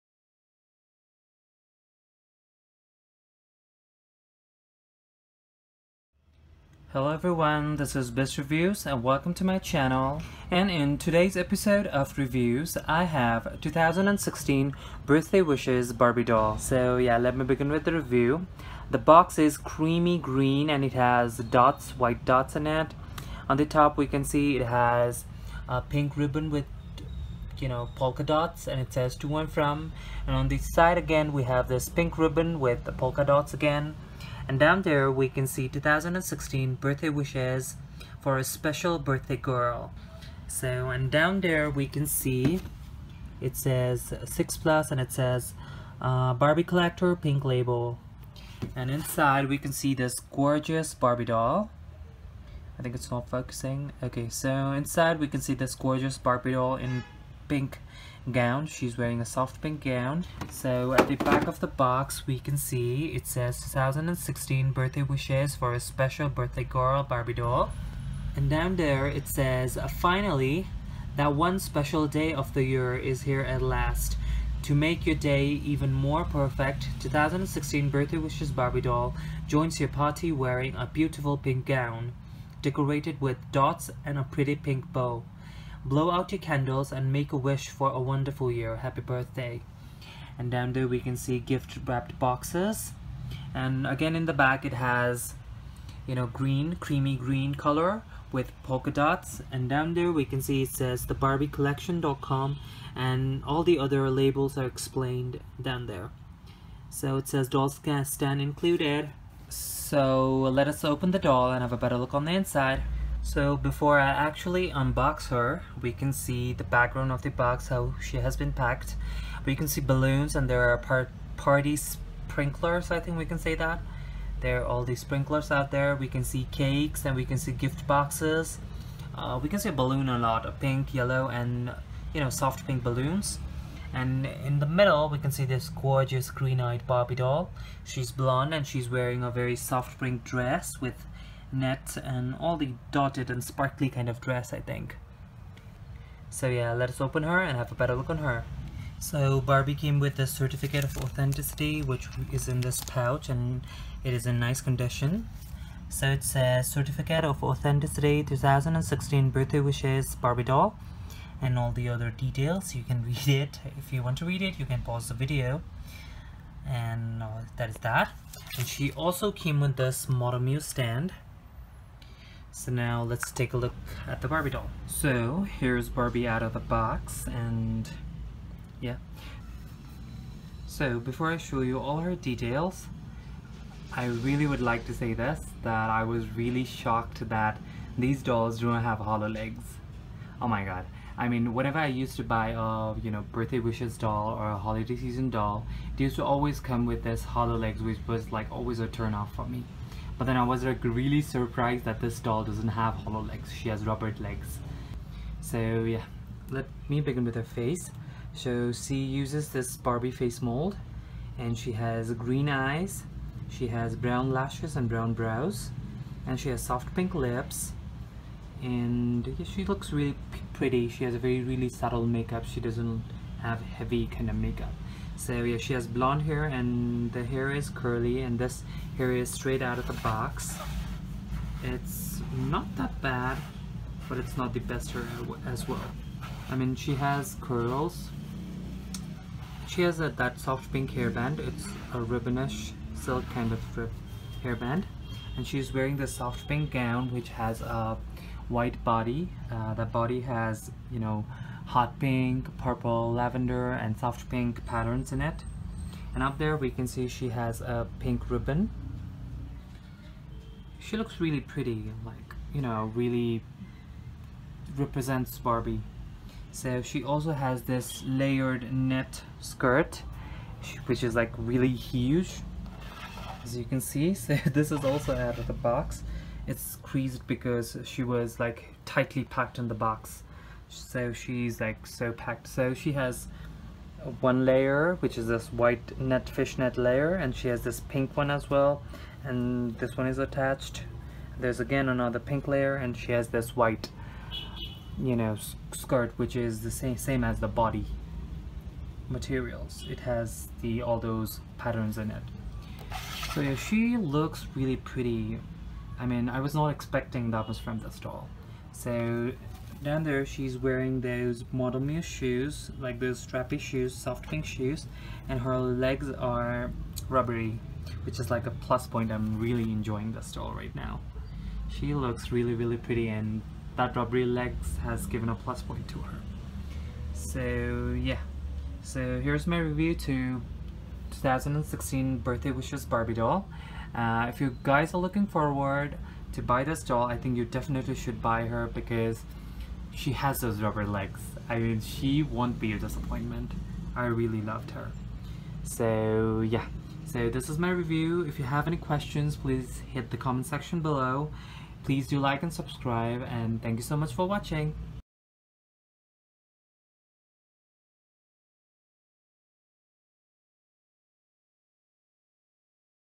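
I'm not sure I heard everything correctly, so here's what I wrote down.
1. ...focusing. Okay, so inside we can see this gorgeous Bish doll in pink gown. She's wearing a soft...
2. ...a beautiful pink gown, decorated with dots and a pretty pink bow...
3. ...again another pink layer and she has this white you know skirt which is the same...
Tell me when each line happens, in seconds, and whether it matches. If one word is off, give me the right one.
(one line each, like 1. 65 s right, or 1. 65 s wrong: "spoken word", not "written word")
1. 53 s wrong: "Barbie", not "Bish"
2. 80 s right
3. 291 s right.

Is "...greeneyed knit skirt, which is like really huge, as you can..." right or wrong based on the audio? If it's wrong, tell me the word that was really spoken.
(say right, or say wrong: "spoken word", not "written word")
wrong: "layered", not "greeneyed".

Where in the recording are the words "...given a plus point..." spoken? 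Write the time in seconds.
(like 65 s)
325 s.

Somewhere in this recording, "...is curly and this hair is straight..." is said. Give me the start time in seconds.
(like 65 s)
227 s.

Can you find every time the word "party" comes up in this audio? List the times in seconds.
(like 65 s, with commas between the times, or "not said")
79 s, 121 s.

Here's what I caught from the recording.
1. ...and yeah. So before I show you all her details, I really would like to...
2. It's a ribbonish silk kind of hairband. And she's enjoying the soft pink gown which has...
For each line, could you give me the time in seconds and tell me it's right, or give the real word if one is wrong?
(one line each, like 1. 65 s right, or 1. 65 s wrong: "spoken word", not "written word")
1. 177 s right
2. 241 s wrong: "wearing", not "enjoying".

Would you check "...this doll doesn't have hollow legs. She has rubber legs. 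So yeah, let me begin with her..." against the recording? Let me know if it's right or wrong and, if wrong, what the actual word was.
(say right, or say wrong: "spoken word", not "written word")
right.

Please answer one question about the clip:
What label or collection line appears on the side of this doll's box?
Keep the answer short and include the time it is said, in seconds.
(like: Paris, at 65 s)
Pink label, at 47 s.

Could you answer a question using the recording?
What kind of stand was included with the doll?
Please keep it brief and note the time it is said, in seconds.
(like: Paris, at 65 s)
Model muse stand, at 170 s.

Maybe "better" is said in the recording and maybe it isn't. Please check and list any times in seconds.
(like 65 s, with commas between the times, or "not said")
111 s, 147 s.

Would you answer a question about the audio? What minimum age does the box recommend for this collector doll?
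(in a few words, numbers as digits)
6+.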